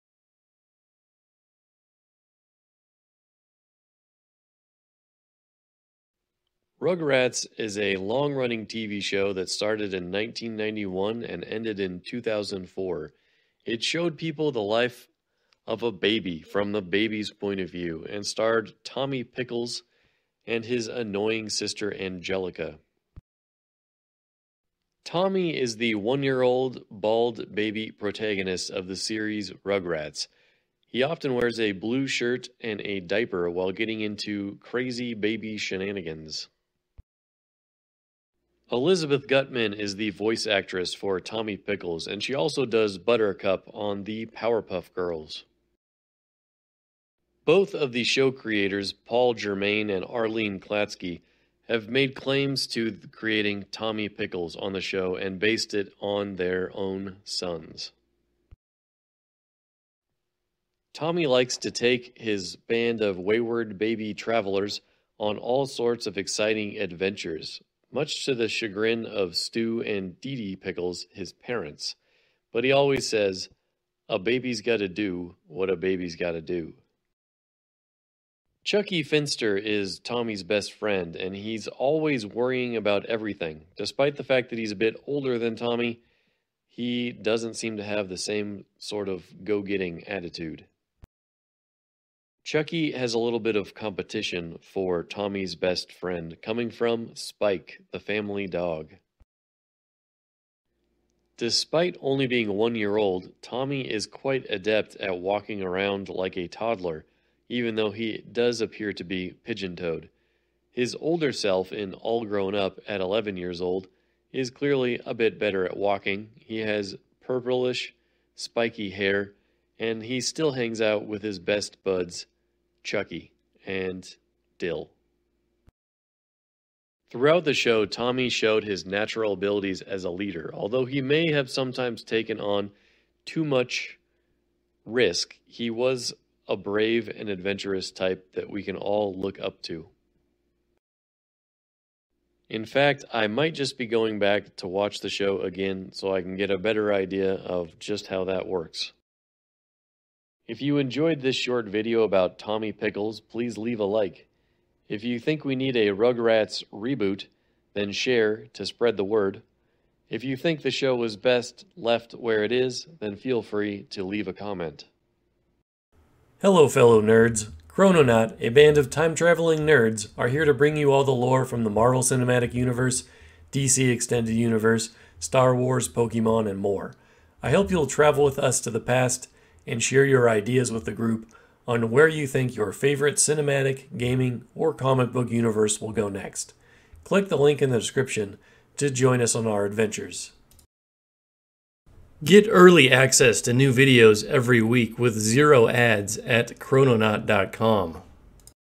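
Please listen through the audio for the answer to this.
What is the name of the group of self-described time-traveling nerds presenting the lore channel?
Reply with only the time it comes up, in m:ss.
2:47.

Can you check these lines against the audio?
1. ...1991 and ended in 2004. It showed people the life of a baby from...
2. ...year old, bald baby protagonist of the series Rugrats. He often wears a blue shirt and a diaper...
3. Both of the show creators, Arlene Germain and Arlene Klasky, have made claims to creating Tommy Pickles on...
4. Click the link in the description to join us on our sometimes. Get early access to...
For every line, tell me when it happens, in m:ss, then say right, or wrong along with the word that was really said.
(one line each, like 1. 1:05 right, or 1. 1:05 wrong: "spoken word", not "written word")
1. 0:10 right
2. 0:26 right
3. 0:47 wrong: "Paul", not "Arlene"
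4. 3:07 wrong: "adventures", not "sometimes".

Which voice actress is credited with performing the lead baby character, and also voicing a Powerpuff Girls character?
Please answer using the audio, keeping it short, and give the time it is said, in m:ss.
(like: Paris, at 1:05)
Elizabeth Guttman, at 0:38.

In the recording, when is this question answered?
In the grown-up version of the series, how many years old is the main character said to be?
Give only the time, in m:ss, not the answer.
1:52.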